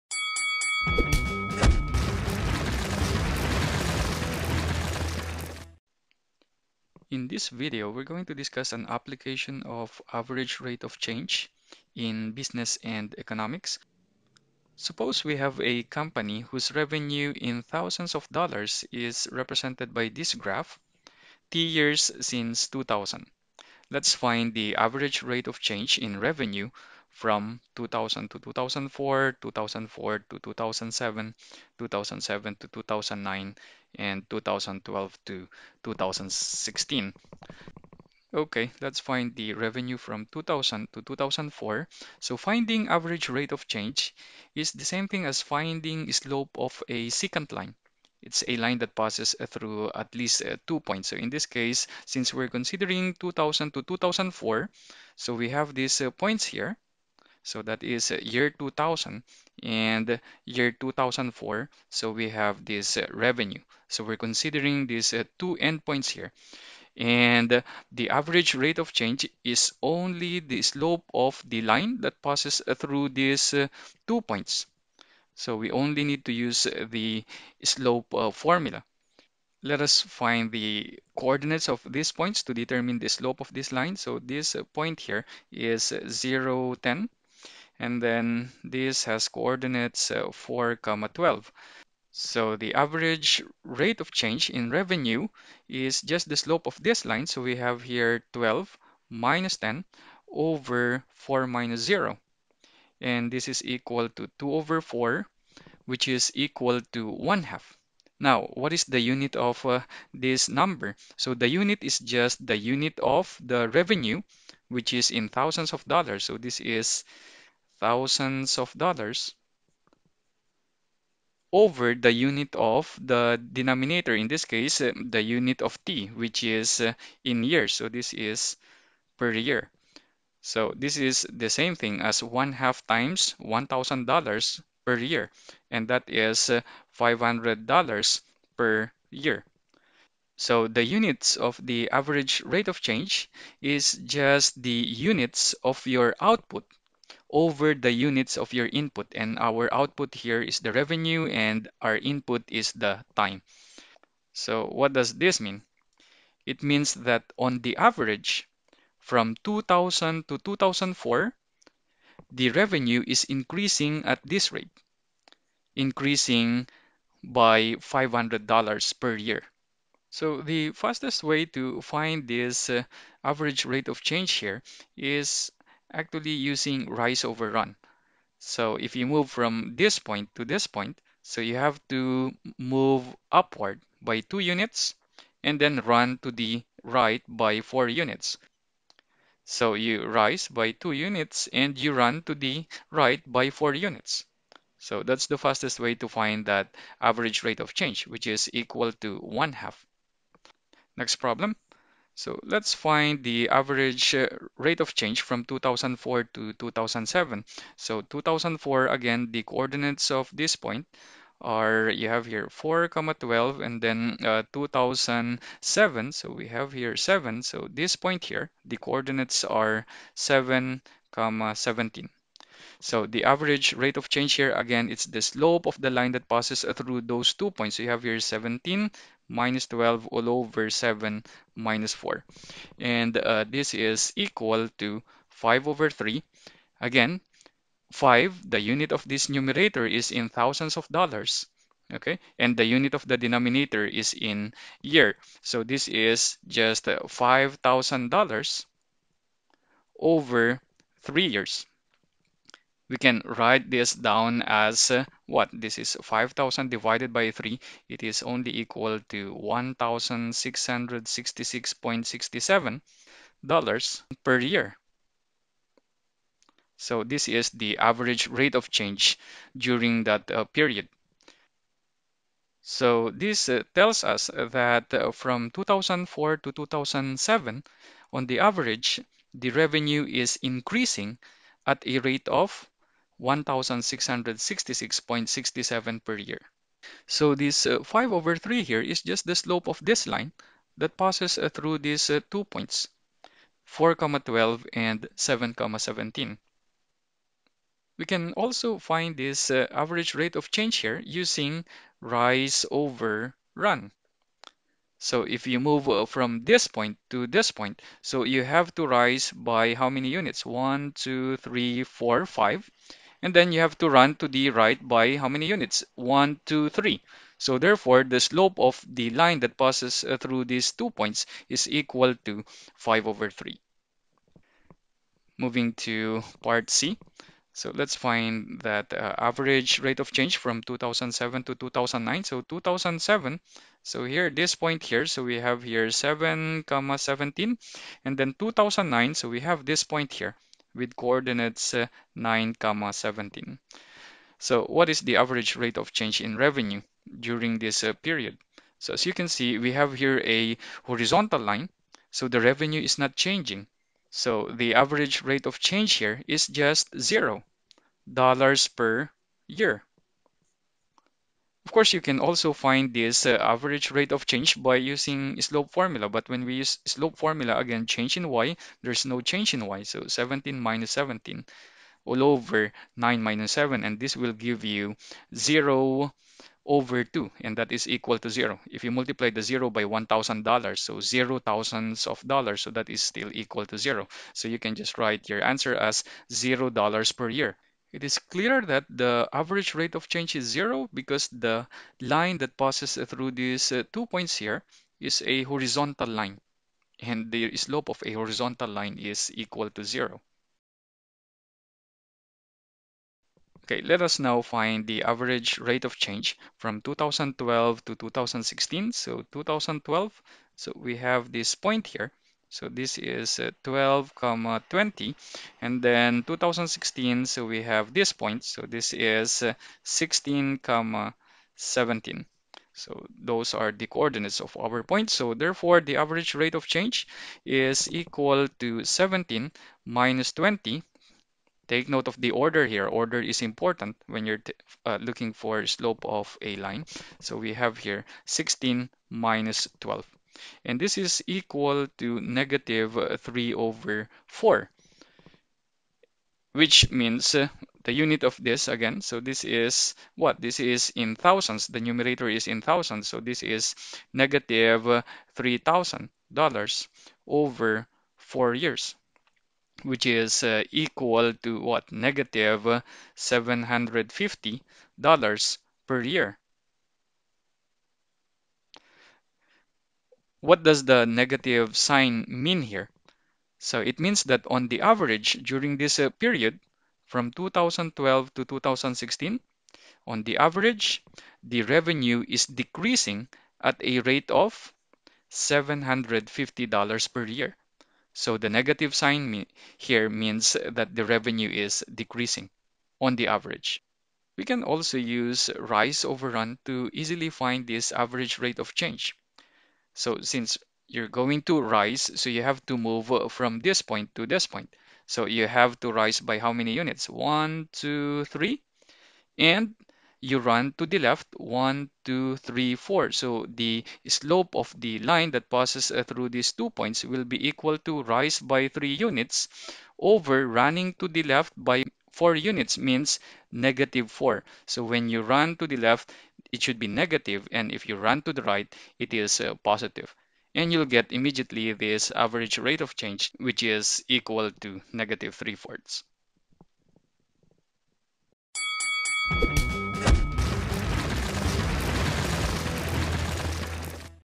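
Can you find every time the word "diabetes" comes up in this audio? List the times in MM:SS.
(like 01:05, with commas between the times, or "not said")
not said.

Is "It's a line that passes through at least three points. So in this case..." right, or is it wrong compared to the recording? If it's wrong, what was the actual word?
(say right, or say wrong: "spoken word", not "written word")
wrong: "two", not "three".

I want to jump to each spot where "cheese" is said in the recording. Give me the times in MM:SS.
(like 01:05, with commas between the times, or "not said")
not said.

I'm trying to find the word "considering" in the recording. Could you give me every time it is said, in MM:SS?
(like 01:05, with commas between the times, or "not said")
00:52, 01:04.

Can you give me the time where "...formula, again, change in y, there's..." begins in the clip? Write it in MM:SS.
06:07.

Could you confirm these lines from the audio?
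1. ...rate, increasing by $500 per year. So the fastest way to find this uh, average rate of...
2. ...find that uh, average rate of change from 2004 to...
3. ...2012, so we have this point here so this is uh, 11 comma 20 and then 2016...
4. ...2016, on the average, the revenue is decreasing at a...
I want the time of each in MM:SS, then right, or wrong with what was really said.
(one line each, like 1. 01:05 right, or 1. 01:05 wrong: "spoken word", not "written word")
1. 02:44 right
2. 05:27 wrong: "2007", not "2004"
3. 06:49 wrong: "12", not "11"
4. 07:58 right.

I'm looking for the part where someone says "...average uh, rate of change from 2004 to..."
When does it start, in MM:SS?
03:23.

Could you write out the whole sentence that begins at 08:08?
So the negative sign me here means that the revenue is decreasing on the average.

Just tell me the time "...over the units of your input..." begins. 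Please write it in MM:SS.
02:27.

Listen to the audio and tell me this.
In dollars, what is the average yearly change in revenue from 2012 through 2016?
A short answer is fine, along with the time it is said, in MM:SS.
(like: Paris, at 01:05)
-$750 per year, at 07:41.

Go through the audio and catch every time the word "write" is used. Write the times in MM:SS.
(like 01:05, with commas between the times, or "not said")
04:13, 06:24.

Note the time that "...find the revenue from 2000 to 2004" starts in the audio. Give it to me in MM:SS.
00:39.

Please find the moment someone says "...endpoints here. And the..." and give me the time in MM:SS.
01:05.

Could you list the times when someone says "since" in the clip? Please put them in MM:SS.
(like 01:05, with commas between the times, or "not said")
00:22, 00:52, 08:20.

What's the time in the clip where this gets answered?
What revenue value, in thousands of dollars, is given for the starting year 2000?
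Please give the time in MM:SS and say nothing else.
01:26.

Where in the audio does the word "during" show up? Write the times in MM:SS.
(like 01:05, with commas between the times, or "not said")
04:29, 05:47, 07:55.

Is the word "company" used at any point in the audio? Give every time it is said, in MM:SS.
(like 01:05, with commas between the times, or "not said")
00:15.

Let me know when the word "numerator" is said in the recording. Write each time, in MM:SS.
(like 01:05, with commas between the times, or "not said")
03:59, 07:31.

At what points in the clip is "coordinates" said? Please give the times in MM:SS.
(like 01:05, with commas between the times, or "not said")
01:21, 01:29, 03:29, 03:38, 05:40, 07:03.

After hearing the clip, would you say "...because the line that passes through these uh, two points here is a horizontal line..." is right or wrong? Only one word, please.
right.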